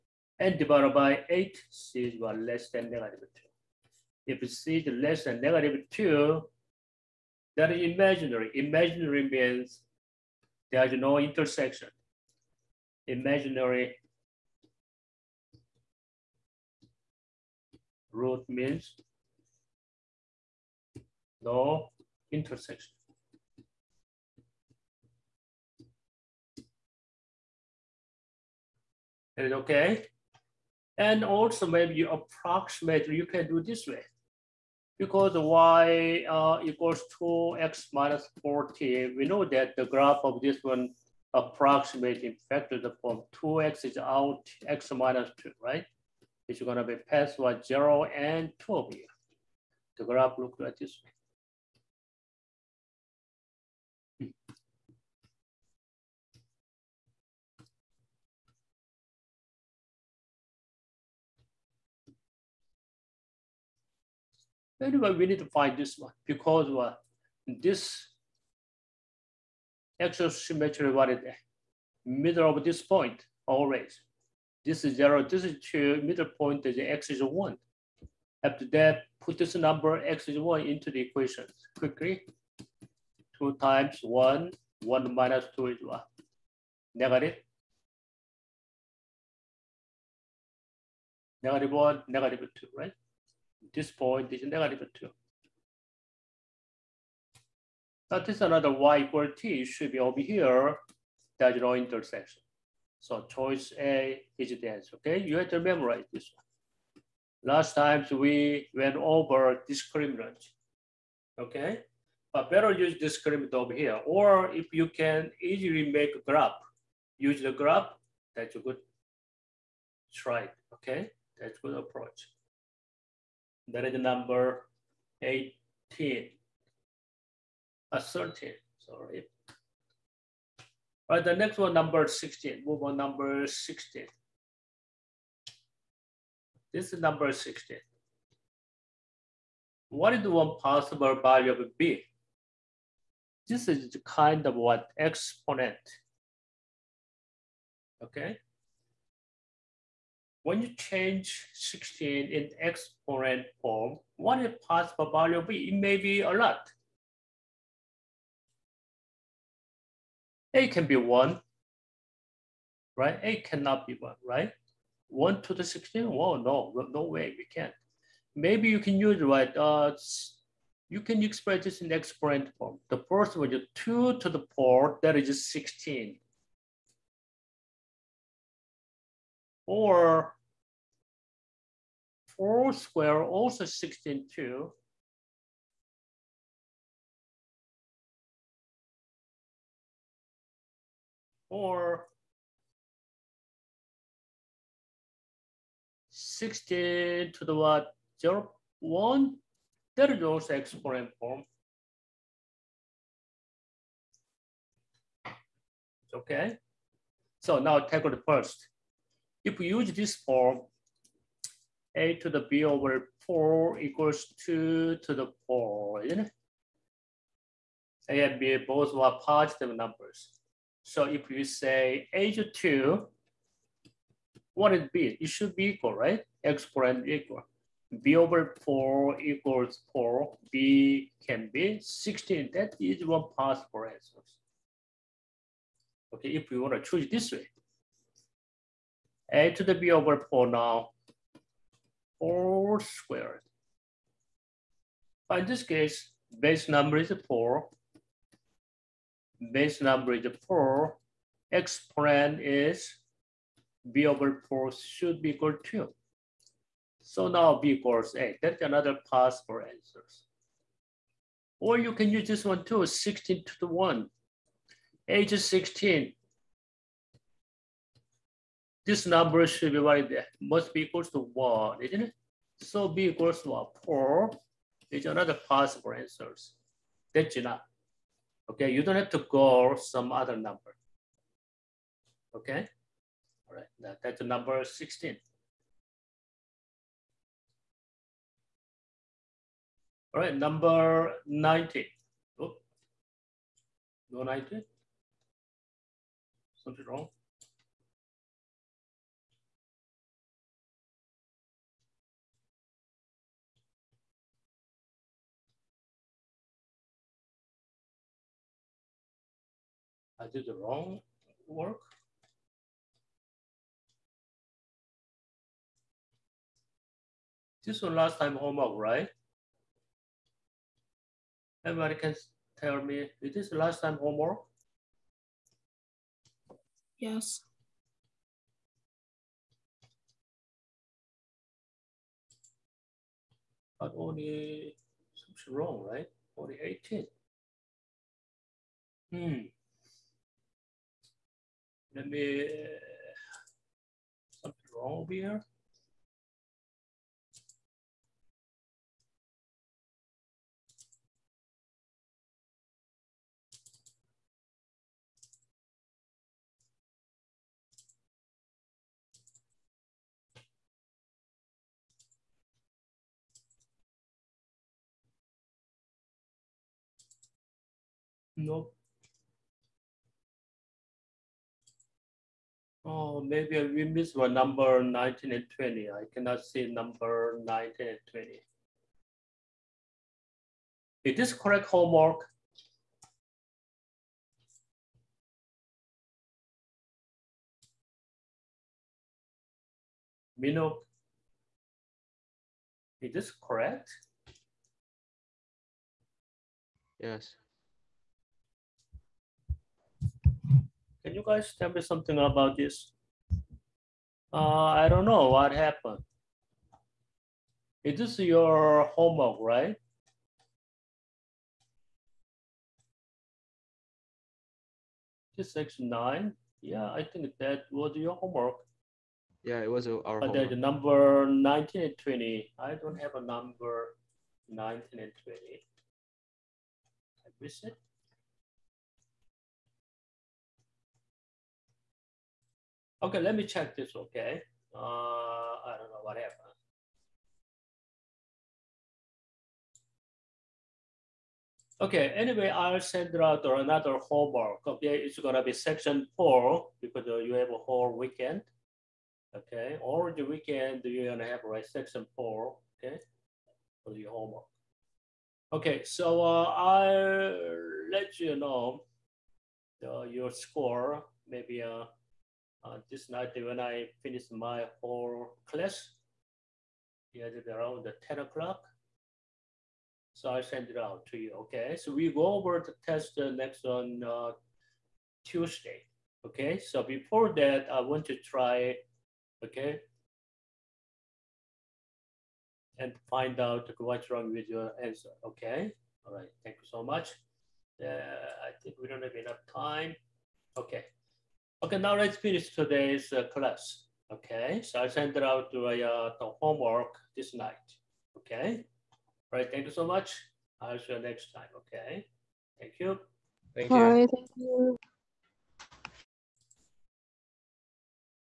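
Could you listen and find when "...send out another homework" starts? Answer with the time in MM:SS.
07:22.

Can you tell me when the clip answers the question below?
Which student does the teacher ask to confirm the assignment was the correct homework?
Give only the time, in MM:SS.
06:30.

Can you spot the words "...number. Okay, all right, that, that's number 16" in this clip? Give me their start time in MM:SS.
04:40.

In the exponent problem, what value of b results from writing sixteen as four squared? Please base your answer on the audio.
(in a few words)
8.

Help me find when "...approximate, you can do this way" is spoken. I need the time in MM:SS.
00:32.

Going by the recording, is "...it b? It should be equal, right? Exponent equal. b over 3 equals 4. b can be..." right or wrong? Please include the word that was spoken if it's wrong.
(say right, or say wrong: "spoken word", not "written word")
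wrong: "4", not "3".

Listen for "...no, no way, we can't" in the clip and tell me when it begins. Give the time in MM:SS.
02:46.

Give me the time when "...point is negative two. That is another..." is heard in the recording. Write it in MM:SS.
01:33.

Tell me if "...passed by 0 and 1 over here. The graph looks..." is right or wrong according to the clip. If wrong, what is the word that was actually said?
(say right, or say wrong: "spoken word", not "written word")
wrong: "2", not "1".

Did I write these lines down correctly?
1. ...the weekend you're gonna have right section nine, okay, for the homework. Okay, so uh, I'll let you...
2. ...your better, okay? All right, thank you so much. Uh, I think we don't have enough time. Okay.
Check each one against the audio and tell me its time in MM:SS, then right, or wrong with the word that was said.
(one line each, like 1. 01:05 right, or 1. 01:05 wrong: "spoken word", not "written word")
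1. 07:30 wrong: "four", not "nine"
2. 08:04 wrong: "answer", not "better".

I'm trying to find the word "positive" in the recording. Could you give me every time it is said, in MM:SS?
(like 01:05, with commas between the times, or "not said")
03:39.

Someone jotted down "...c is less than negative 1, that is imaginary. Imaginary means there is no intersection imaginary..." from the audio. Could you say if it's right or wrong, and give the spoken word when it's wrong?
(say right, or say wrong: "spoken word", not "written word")
wrong: "2", not "1".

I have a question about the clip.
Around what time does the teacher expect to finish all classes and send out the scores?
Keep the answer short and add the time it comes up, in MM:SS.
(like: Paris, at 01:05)
10 o'clock, at 07:48.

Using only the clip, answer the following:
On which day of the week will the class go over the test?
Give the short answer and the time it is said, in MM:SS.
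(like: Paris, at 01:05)
Tuesday, at 07:55.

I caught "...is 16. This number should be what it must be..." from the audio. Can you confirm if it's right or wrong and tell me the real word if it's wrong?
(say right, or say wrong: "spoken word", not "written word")
right.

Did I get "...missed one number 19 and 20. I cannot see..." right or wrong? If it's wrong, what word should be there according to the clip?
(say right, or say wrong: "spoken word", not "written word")
right.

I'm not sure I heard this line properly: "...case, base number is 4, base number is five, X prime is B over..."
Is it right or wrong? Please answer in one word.
wrong.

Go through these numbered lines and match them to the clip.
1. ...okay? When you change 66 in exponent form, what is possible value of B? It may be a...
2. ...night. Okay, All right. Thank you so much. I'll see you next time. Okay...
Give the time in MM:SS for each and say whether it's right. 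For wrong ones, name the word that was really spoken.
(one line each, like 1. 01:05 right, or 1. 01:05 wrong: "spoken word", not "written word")
1. 02:28 wrong: "16", not "66"
2. 08:17 right.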